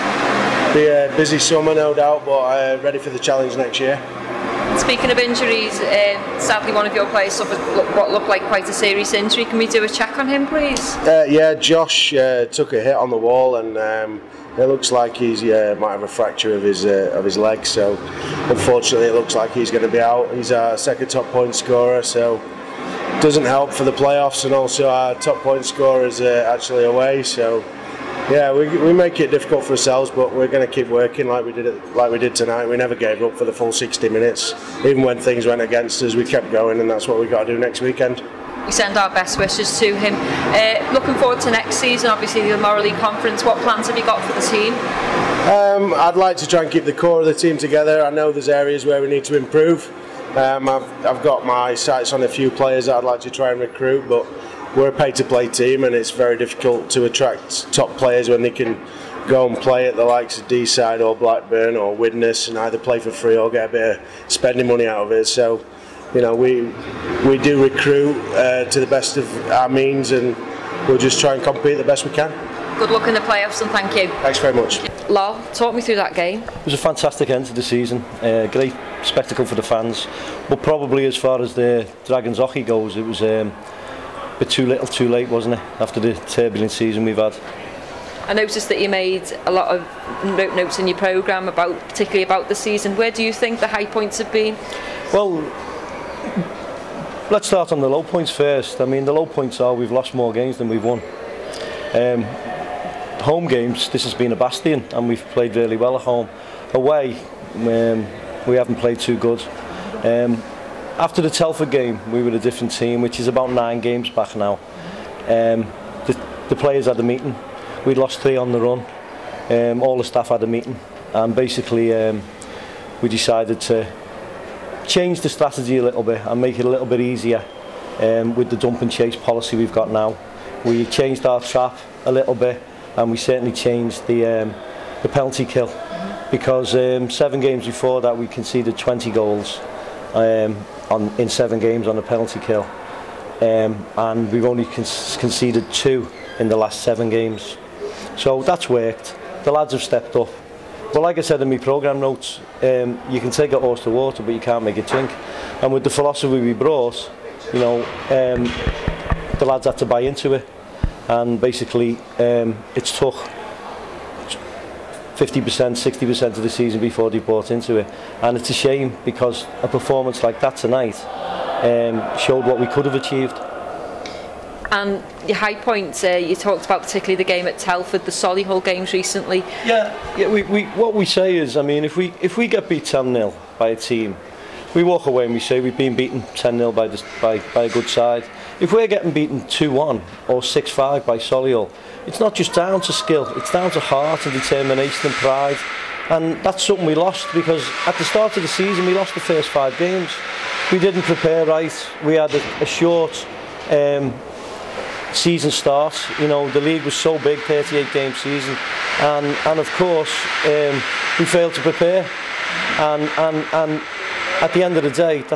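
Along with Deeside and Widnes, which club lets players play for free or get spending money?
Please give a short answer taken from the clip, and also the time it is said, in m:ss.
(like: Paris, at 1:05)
Blackburn, at 1:01.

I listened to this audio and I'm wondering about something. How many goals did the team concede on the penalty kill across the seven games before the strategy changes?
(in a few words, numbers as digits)
20.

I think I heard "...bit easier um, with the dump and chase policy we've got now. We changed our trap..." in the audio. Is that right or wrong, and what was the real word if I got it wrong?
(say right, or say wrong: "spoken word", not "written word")
right.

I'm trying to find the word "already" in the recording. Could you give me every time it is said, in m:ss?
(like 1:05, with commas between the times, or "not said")
not said.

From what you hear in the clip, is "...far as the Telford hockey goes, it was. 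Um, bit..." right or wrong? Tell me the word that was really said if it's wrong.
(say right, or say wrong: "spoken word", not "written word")
wrong: "Dragons", not "Telford".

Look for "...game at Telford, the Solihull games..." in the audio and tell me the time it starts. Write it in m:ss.
2:57.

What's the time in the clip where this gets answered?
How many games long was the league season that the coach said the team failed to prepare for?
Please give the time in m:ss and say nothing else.
3:27.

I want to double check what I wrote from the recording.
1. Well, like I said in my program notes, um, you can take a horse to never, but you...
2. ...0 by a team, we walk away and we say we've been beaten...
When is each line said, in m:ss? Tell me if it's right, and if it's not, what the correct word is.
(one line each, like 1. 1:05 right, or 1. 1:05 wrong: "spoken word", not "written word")
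1. 2:30 wrong: "water", not "never"
2. 3:03 right.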